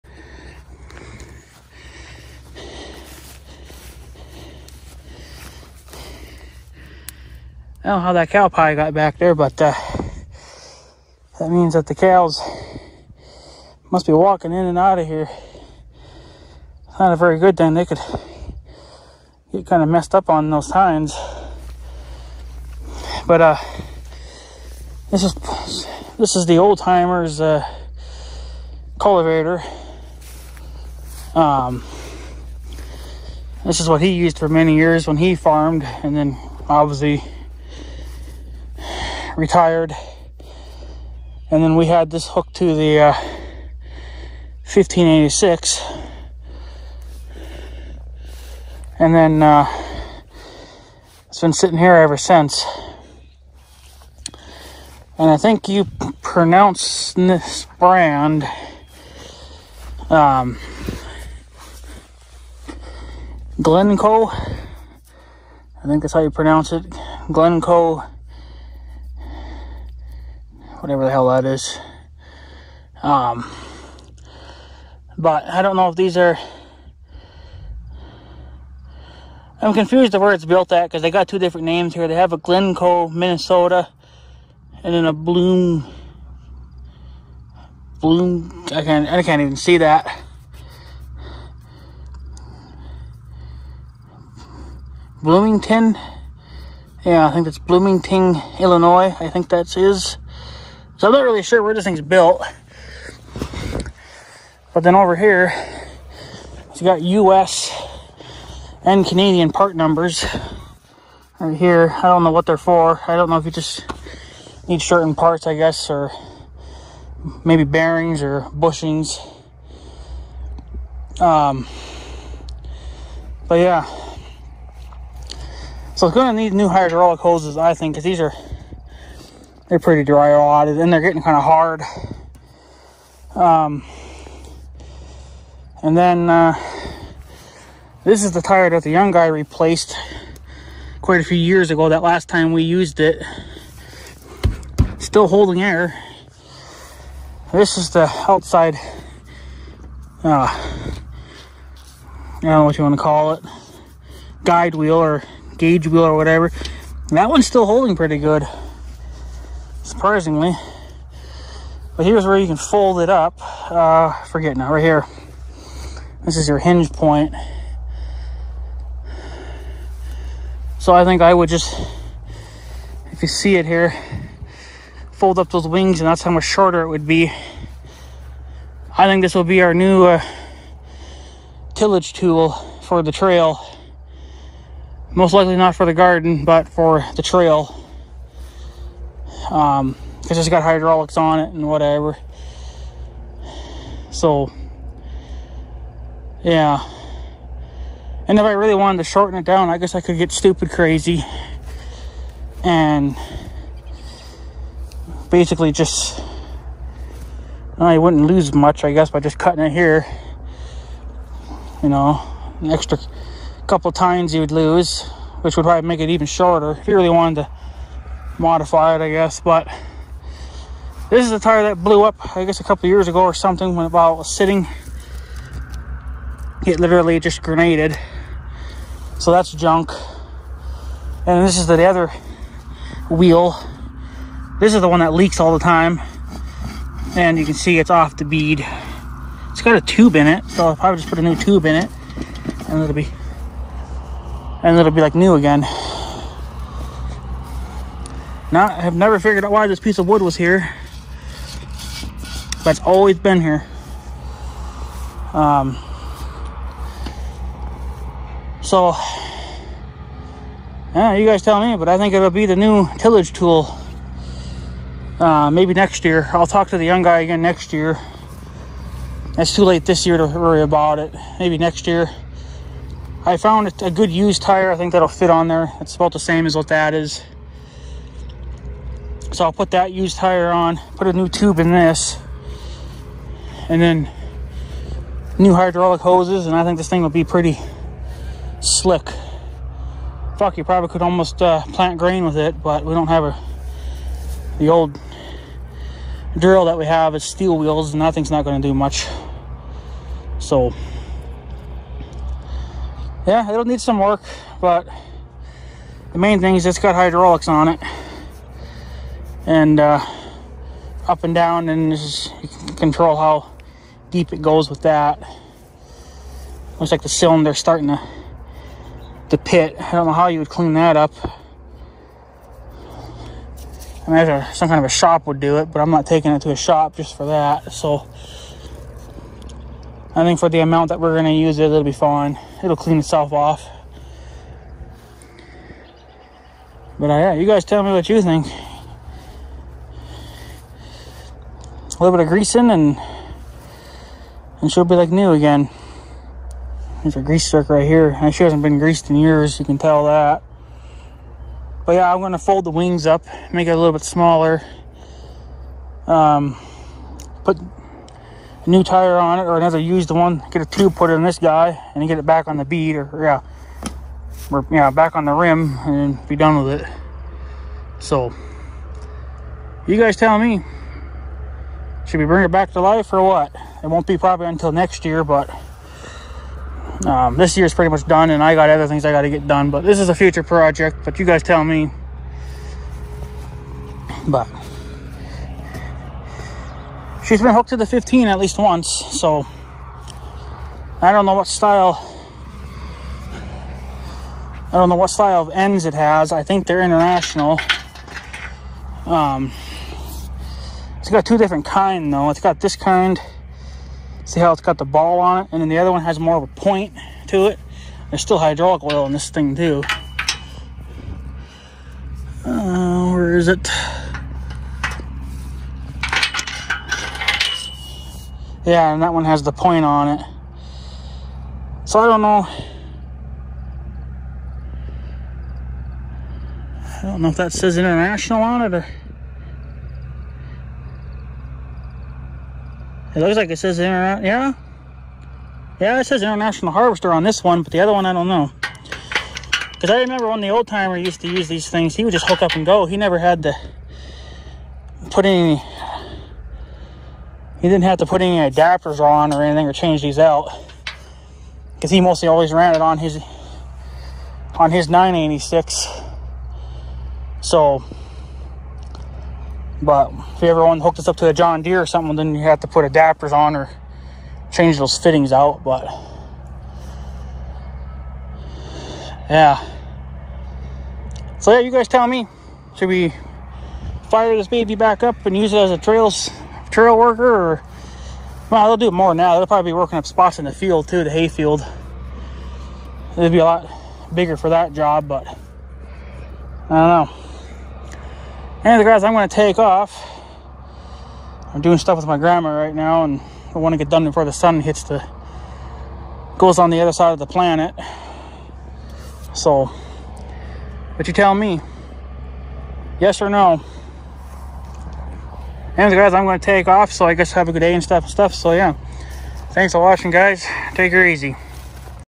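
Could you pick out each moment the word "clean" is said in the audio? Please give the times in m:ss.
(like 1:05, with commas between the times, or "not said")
5:20, 5:32.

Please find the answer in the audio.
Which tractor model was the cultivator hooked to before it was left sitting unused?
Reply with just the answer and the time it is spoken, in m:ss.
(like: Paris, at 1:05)
1586, at 0:44.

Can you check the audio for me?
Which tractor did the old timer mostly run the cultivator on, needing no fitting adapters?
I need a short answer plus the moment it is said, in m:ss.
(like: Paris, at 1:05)
986, at 7:34.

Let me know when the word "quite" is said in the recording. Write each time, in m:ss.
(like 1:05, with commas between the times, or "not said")
2:21.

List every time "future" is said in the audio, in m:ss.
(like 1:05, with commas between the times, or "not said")
6:20.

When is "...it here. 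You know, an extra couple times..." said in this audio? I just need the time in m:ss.
3:29.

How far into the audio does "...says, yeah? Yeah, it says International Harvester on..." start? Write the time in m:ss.
7:13.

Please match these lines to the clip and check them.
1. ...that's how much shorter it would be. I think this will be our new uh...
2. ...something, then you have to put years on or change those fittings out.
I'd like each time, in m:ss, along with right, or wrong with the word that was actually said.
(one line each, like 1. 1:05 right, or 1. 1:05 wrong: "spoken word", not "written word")
1. 2:56 right
2. 7:41 wrong: "adapters", not "years".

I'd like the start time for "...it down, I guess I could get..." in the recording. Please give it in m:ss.
3:19.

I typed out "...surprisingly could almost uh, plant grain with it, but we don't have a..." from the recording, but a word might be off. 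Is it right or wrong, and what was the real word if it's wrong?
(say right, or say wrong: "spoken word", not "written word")
wrong: "probably", not "surprisingly".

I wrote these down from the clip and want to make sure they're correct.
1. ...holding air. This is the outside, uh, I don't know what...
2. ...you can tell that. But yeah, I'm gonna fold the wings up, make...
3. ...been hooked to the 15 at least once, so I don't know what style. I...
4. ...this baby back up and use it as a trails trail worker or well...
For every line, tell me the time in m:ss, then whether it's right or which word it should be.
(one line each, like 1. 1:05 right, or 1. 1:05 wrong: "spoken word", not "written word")
1. 2:25 right
2. 5:49 right
3. 6:27 right
4. 7:54 right.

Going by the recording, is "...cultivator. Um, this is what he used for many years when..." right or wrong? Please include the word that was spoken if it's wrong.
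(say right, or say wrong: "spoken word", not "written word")
right.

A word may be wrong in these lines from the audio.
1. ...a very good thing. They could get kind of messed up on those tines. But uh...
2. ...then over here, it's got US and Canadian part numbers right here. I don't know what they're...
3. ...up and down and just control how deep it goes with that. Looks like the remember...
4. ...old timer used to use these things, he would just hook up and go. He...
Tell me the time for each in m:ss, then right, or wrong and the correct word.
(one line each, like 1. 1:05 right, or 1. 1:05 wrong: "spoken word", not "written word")
1. 0:17 right
2. 1:44 right
3. 5:11 wrong: "cylinder", not "remember"
4. 7:20 right.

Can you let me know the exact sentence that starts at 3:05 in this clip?
Most likely not for the garden, but for the trail um, it's got hydraulics on it and whatever.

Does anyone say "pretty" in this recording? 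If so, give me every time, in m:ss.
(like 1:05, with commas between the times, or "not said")
2:09, 2:37, 4:47, 6:17.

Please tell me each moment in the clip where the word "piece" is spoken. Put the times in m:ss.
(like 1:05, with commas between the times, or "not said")
4:09.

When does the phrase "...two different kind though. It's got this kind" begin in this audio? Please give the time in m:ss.
6:41.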